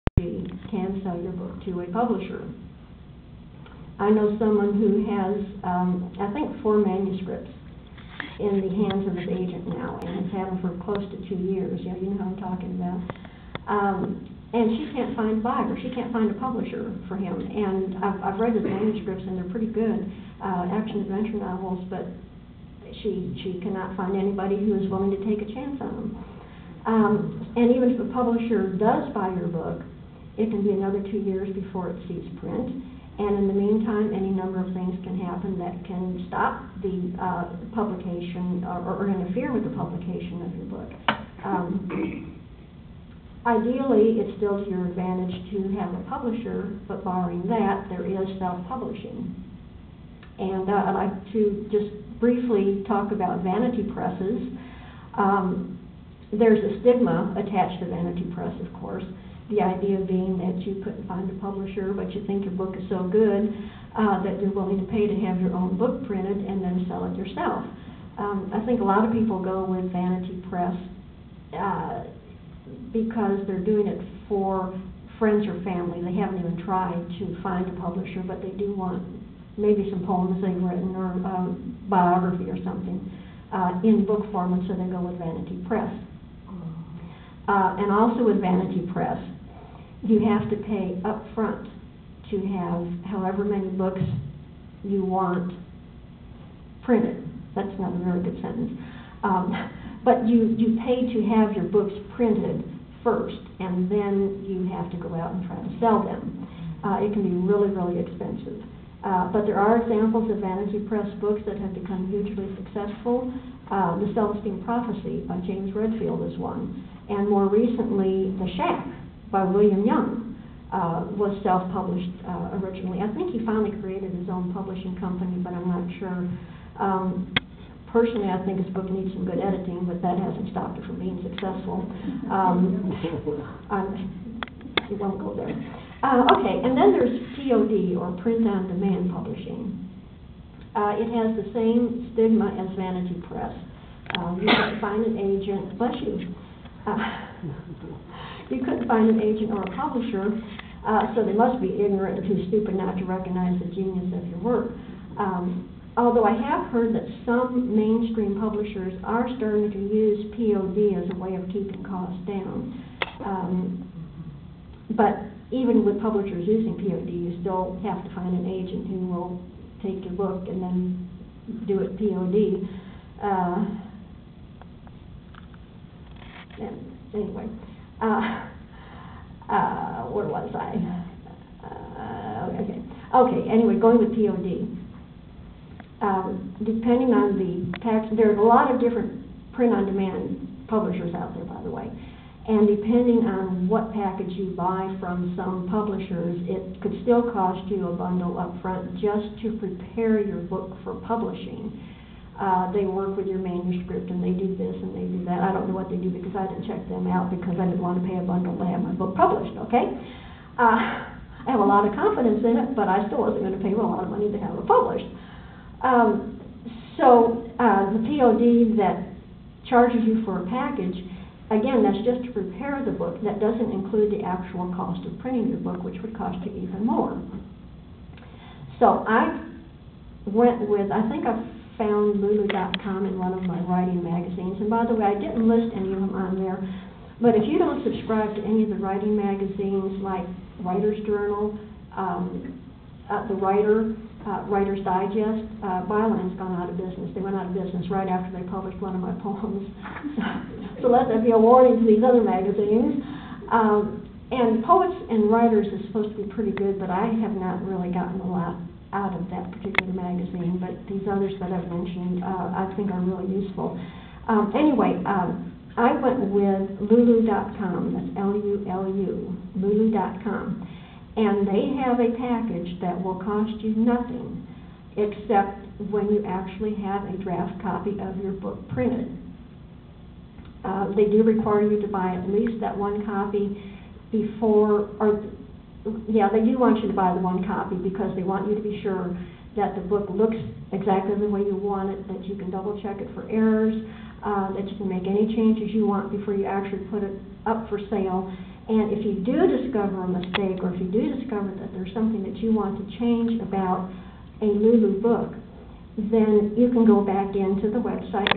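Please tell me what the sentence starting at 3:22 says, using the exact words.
Uh, they work with your manuscript and they do this and they do that.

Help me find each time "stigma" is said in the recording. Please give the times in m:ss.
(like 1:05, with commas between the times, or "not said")
0:56, 2:22.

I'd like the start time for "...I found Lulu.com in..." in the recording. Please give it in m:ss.
3:51.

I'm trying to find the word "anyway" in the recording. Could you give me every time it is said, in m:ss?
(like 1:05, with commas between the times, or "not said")
2:57, 3:03, 4:24.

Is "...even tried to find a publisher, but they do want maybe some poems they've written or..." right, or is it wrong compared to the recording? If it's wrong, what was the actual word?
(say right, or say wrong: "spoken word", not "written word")
right.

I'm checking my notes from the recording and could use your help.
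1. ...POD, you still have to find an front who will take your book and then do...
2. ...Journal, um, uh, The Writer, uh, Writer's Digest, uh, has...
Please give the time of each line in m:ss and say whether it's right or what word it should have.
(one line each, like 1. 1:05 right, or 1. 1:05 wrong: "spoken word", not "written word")
1. 2:46 wrong: "agent", not "front"
2. 4:01 right.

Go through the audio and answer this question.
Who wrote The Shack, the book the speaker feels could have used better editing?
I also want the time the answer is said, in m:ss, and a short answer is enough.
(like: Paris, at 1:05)
William Young, at 1:59.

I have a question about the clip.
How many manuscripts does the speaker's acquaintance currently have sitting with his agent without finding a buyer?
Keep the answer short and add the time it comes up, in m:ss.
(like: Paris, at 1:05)
4, at 0:06.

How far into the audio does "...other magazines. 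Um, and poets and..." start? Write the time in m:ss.
4:12.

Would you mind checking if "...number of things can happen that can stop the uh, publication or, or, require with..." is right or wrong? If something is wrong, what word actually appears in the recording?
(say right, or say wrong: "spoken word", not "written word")
wrong: "interfere", not "require".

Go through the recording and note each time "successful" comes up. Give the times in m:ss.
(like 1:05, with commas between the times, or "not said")
1:52, 2:11.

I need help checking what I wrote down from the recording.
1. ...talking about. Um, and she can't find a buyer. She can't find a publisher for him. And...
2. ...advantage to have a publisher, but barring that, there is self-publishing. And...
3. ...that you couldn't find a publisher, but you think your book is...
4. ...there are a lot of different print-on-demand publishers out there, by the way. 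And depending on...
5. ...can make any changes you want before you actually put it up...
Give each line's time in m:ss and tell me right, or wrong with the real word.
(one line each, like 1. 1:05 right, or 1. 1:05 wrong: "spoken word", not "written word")
1. 0:12 right
2. 0:44 right
3. 1:00 right
4. 3:08 right
5. 4:54 right.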